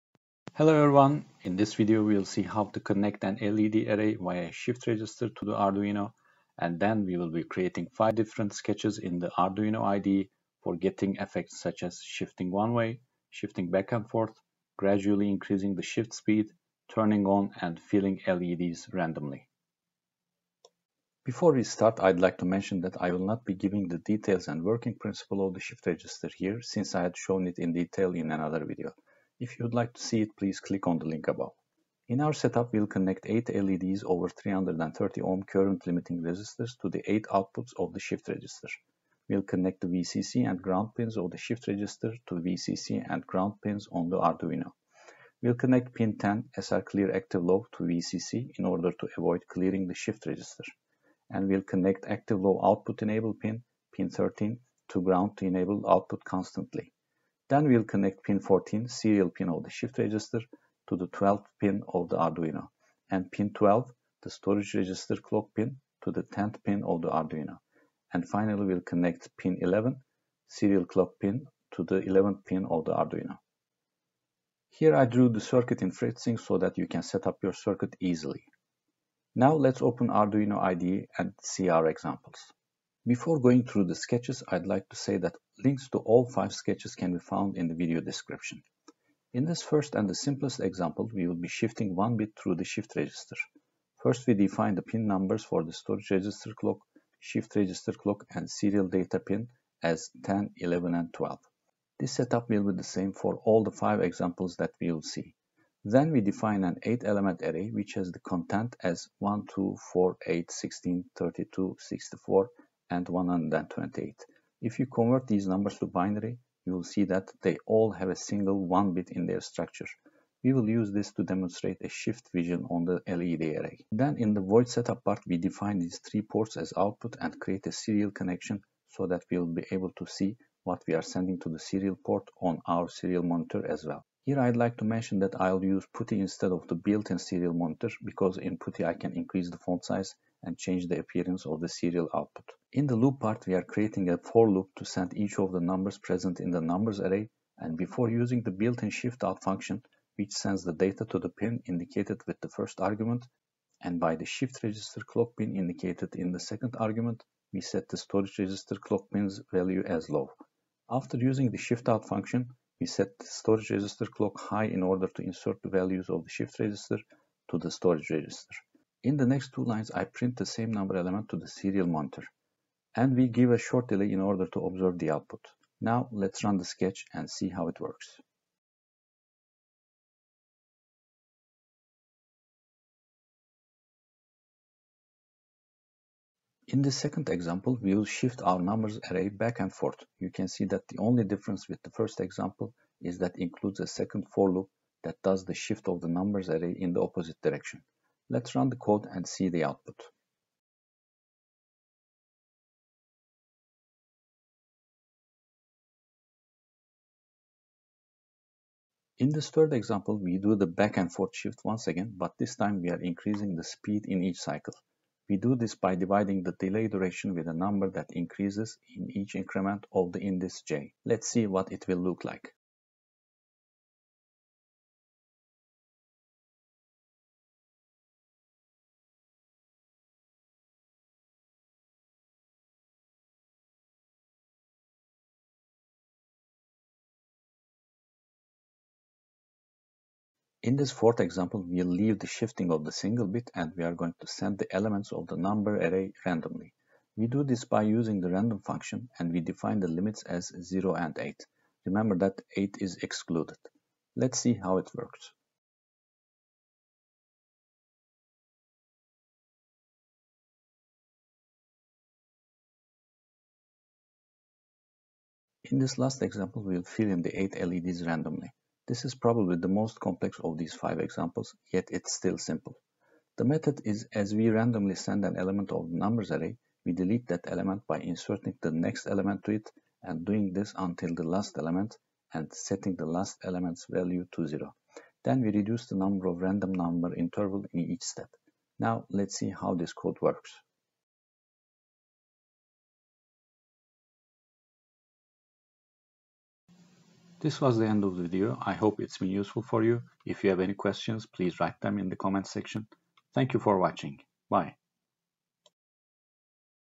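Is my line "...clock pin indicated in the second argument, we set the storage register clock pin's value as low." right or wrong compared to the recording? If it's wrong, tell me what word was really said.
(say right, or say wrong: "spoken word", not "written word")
right.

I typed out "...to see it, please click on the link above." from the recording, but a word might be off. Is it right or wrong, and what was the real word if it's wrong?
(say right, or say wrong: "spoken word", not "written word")
right.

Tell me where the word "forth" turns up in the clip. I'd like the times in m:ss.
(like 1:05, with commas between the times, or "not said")
0:14, 3:09, 3:31.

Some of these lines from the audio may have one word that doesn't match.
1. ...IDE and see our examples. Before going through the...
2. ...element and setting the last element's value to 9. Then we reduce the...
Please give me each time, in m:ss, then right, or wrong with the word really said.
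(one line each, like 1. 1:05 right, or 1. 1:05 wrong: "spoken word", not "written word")
1. 1:20 right
2. 4:41 wrong: "0", not "9".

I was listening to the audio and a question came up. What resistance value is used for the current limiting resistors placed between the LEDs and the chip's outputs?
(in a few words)
330 ohm.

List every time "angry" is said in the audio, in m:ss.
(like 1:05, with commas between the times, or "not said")
not said.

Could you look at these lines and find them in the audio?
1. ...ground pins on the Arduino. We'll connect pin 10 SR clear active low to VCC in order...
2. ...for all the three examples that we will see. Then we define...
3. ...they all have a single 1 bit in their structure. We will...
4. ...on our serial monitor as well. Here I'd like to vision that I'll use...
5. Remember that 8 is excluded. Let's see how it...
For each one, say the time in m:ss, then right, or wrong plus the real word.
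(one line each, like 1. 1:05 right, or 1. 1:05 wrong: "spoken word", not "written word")
1. 0:43 right
2. 1:43 wrong: "five", not "three"
3. 1:57 right
4. 2:12 wrong: "mention", not "vision"
5. 4:11 right.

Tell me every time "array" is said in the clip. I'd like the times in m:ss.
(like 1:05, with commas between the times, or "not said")
0:03, 1:47, 2:03, 2:26, 3:09, 3:16, 4:05, 4:36.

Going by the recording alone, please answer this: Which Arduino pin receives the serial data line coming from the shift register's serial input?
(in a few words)
12th pin.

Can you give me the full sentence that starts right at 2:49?
In the next two lines, I print the same number element to the serial monitor.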